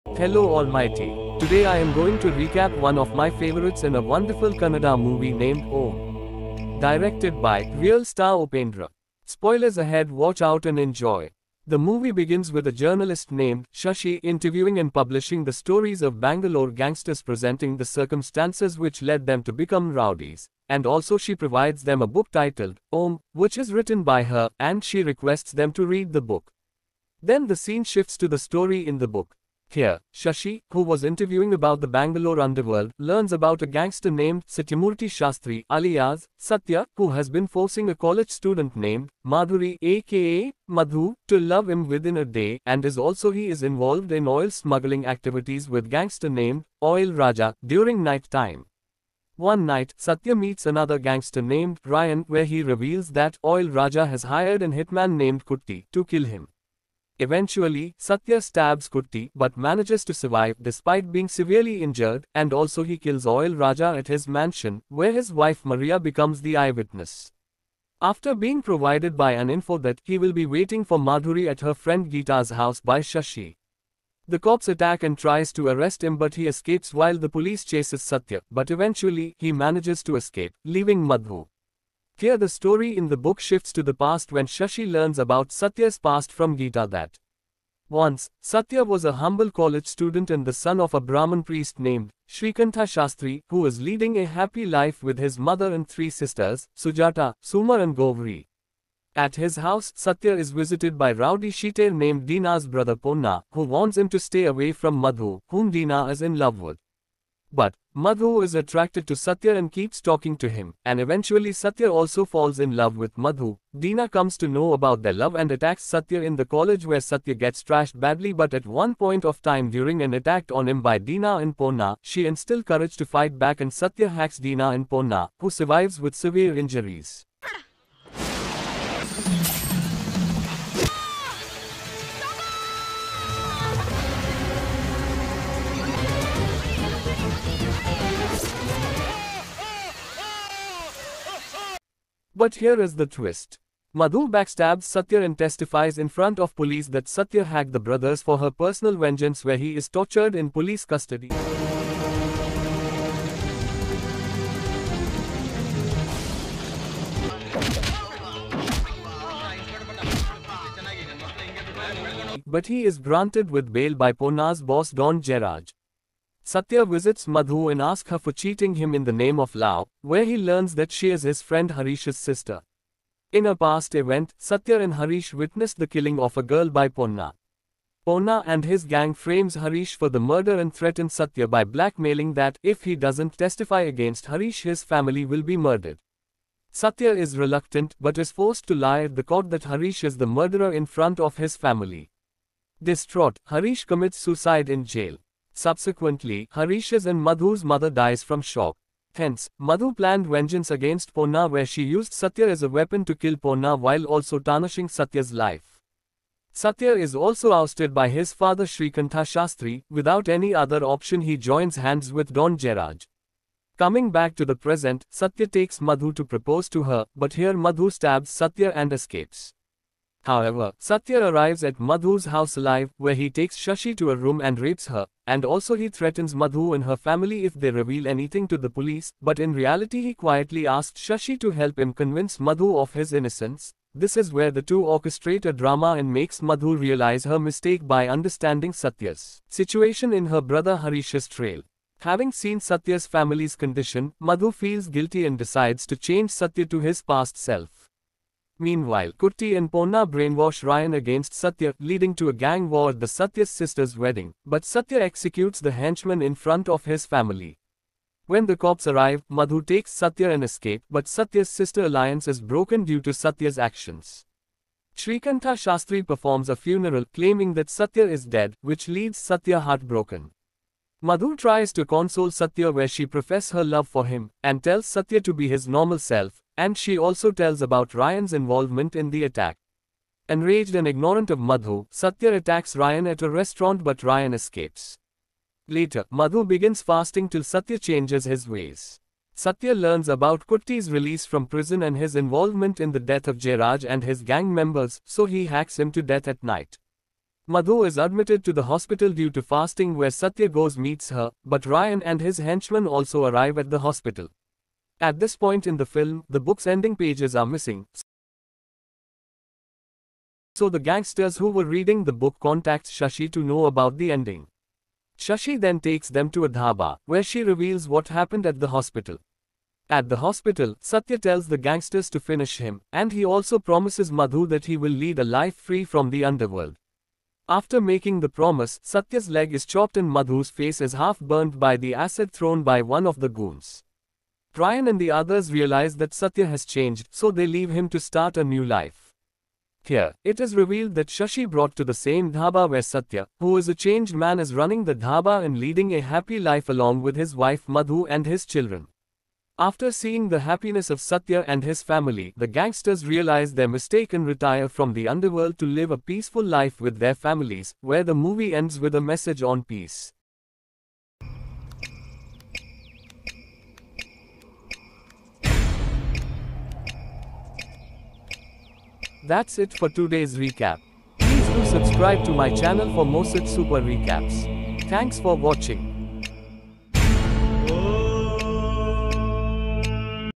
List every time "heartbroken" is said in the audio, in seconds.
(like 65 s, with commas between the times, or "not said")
269 s.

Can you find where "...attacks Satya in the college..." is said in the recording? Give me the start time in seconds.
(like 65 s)
115 s.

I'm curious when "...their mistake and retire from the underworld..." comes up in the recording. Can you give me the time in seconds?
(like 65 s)
353 s.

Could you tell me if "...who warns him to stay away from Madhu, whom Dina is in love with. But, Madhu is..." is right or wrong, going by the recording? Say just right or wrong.
right.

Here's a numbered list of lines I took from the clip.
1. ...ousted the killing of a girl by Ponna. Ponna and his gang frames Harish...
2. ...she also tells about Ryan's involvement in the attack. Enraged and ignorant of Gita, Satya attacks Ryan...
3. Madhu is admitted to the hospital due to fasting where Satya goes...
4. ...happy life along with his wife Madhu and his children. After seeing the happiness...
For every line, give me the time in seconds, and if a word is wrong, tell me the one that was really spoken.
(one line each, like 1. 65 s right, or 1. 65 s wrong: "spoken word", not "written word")
1. 175 s wrong: "witnessed", not "ousted"
2. 276 s wrong: "Madhu", not "Gita"
3. 297 s right
4. 346 s right.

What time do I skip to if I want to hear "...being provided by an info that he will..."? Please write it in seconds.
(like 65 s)
68 s.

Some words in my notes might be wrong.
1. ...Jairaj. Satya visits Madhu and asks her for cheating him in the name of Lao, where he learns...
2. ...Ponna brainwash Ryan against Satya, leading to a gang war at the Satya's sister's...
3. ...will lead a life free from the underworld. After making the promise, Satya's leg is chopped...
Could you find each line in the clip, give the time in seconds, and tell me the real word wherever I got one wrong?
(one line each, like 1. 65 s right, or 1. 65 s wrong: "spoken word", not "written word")
1. 165 s right
2. 249 s right
3. 324 s right.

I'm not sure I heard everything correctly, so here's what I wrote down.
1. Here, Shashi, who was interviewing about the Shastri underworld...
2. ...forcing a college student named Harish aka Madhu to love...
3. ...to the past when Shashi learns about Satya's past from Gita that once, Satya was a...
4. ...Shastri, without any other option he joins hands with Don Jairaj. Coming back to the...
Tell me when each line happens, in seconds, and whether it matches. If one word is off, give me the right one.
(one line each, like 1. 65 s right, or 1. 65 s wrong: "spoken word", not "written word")
1. 29 s wrong: "Bangalore", not "Shastri"
2. 37 s wrong: "Madhuri", not "Harish"
3. 83 s right
4. 209 s right.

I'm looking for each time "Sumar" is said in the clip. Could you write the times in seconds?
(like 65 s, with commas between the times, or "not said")
97 s.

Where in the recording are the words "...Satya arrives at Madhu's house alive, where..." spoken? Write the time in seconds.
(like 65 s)
220 s.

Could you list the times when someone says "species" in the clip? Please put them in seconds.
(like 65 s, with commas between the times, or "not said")
not said.